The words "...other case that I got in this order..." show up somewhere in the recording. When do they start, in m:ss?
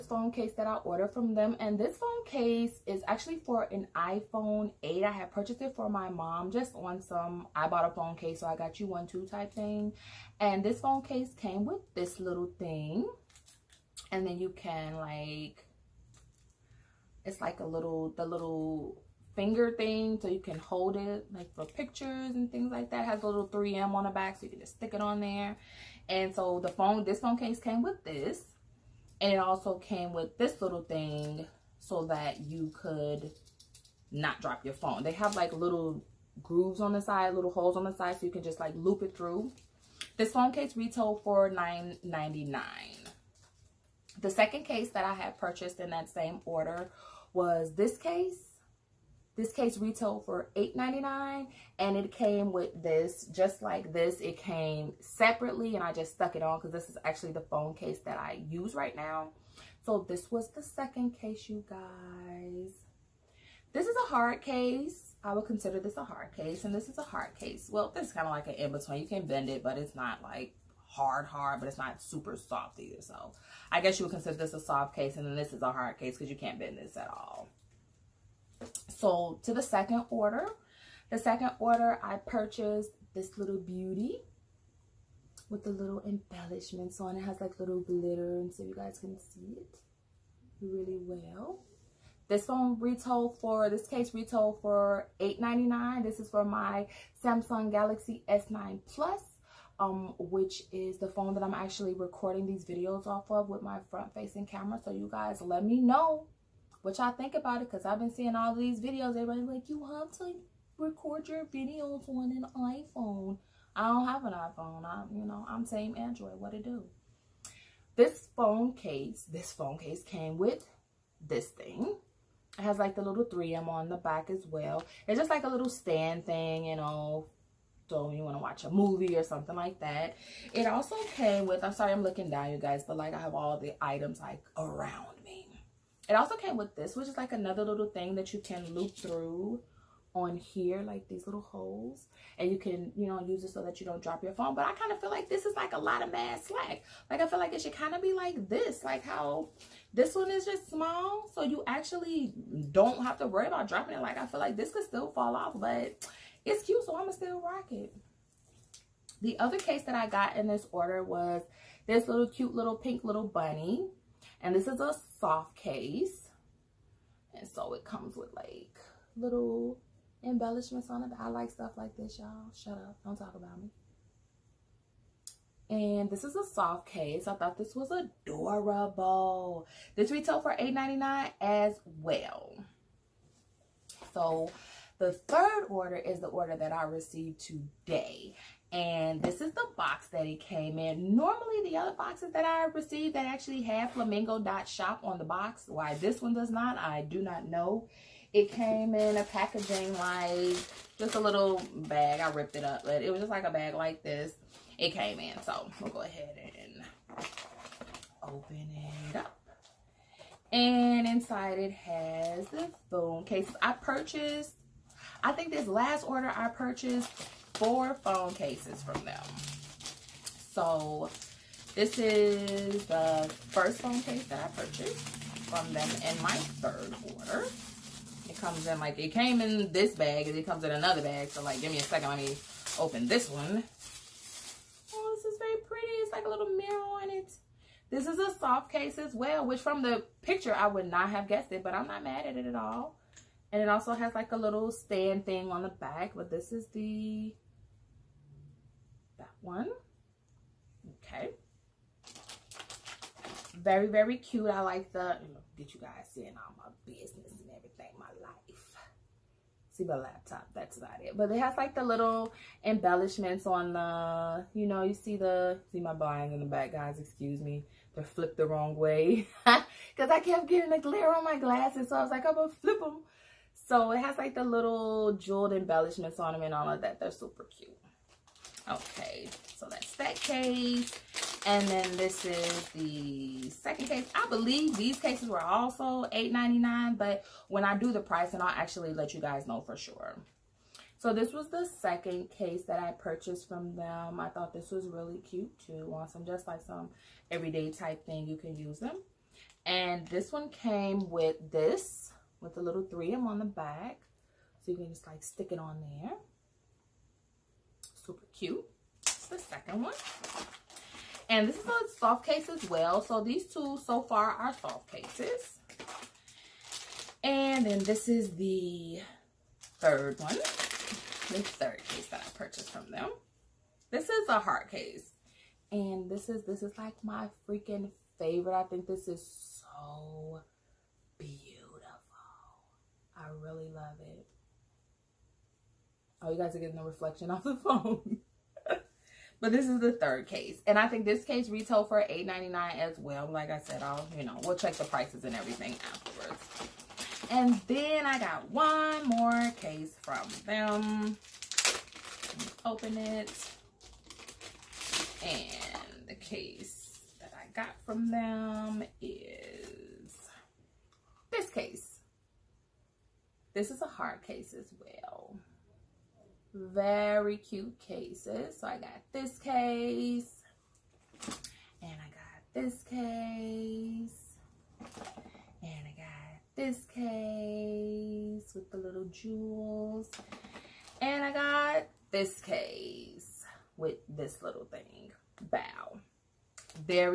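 2:39.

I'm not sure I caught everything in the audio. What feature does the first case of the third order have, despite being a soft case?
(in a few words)
A little mirror.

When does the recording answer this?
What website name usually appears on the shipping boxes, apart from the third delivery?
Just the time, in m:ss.
3:13.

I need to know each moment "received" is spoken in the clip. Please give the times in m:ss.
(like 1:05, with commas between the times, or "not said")
3:06, 3:12.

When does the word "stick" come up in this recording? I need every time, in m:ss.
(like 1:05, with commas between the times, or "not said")
0:24, 5:05.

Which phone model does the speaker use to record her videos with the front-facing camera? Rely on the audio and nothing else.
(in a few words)
Samsung Galaxy S9 Plus.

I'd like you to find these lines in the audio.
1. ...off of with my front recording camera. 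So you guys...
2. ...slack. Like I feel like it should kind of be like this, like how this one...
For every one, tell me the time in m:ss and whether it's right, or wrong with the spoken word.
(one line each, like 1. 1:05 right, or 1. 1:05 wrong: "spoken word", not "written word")
1. 1:43 wrong: "facing", not "recording"
2. 2:26 right.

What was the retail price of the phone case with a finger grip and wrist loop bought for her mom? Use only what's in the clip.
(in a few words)
$9.99.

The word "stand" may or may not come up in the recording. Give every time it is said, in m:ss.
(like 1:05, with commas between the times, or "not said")
2:05, 4:04.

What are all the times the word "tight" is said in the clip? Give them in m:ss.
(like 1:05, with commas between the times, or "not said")
not said.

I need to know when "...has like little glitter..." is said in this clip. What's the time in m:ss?
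1:27.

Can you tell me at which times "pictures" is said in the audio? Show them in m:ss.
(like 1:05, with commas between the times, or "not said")
0:21, 4:00.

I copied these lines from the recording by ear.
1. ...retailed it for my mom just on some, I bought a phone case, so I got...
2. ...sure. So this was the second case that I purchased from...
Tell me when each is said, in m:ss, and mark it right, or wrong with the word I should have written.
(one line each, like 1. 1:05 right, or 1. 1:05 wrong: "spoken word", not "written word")
1. 0:05 wrong: "purchased", not "retailed"
2. 4:49 right.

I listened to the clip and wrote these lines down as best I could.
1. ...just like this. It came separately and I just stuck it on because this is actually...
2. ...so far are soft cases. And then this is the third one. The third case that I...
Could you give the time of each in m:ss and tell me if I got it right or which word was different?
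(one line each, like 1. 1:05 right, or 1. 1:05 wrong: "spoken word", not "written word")
1. 0:53 right
2. 5:13 right.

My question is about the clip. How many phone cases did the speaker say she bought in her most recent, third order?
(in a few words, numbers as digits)
4.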